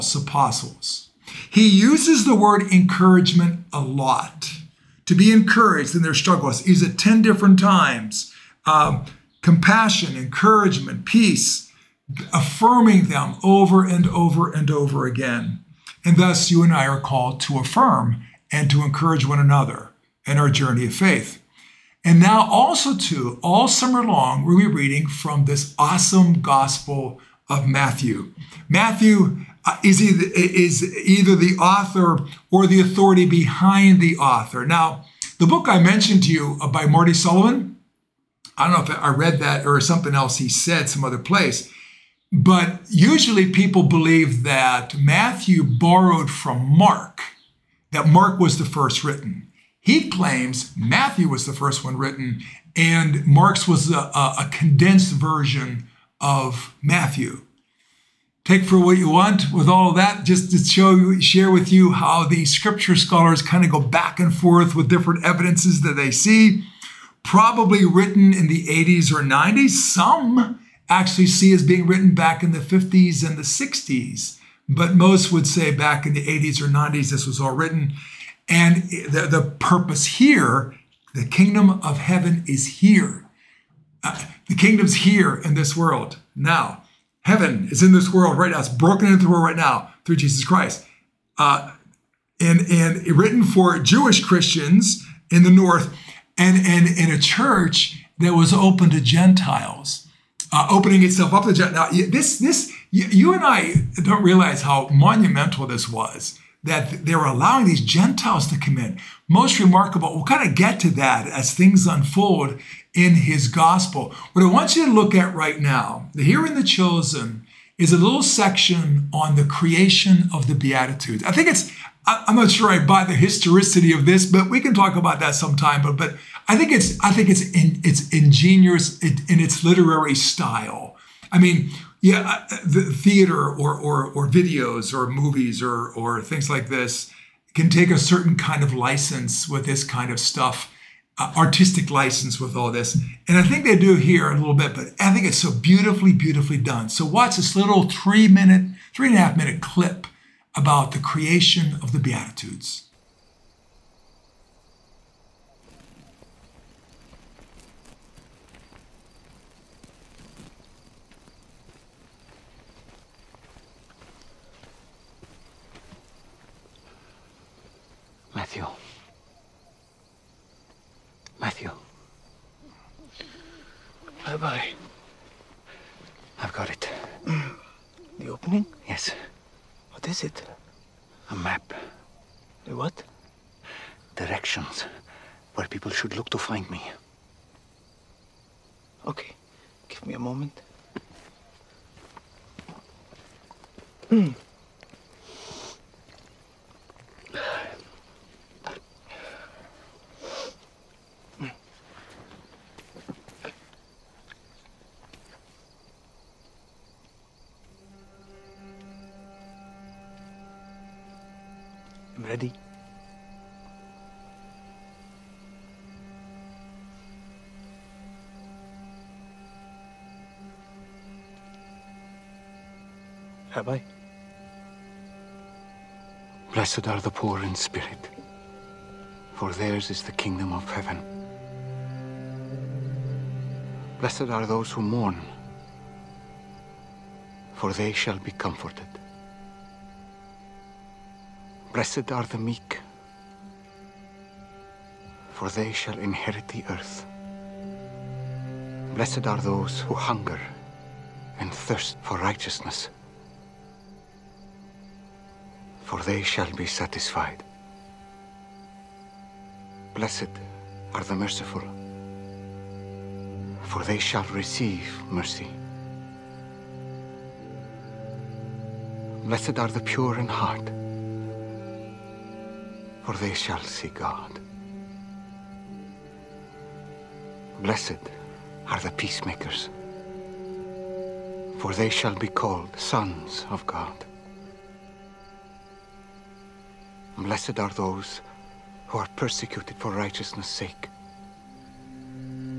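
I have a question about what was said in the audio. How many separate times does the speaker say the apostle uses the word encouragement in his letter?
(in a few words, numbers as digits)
10.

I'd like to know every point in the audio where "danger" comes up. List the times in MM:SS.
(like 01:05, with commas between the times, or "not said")
not said.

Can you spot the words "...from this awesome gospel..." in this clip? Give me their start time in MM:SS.
00:25.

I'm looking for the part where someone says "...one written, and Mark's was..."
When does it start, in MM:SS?
00:51.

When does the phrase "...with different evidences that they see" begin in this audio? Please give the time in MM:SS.
01:04.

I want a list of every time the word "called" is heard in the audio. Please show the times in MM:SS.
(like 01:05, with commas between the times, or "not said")
00:16, 04:42.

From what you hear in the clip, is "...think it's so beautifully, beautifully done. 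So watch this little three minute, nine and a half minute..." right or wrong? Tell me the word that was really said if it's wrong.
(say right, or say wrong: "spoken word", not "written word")
wrong: "three", not "nine".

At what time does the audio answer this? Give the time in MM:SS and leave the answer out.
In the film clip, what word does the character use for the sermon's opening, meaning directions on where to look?
03:01.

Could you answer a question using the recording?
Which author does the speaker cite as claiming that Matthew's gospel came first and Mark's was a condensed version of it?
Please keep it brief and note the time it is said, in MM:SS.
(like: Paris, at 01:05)
Marty Sullivan, at 00:36.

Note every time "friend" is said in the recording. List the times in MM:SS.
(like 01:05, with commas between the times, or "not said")
not said.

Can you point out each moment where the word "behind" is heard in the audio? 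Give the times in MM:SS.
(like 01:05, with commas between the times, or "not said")
00:33.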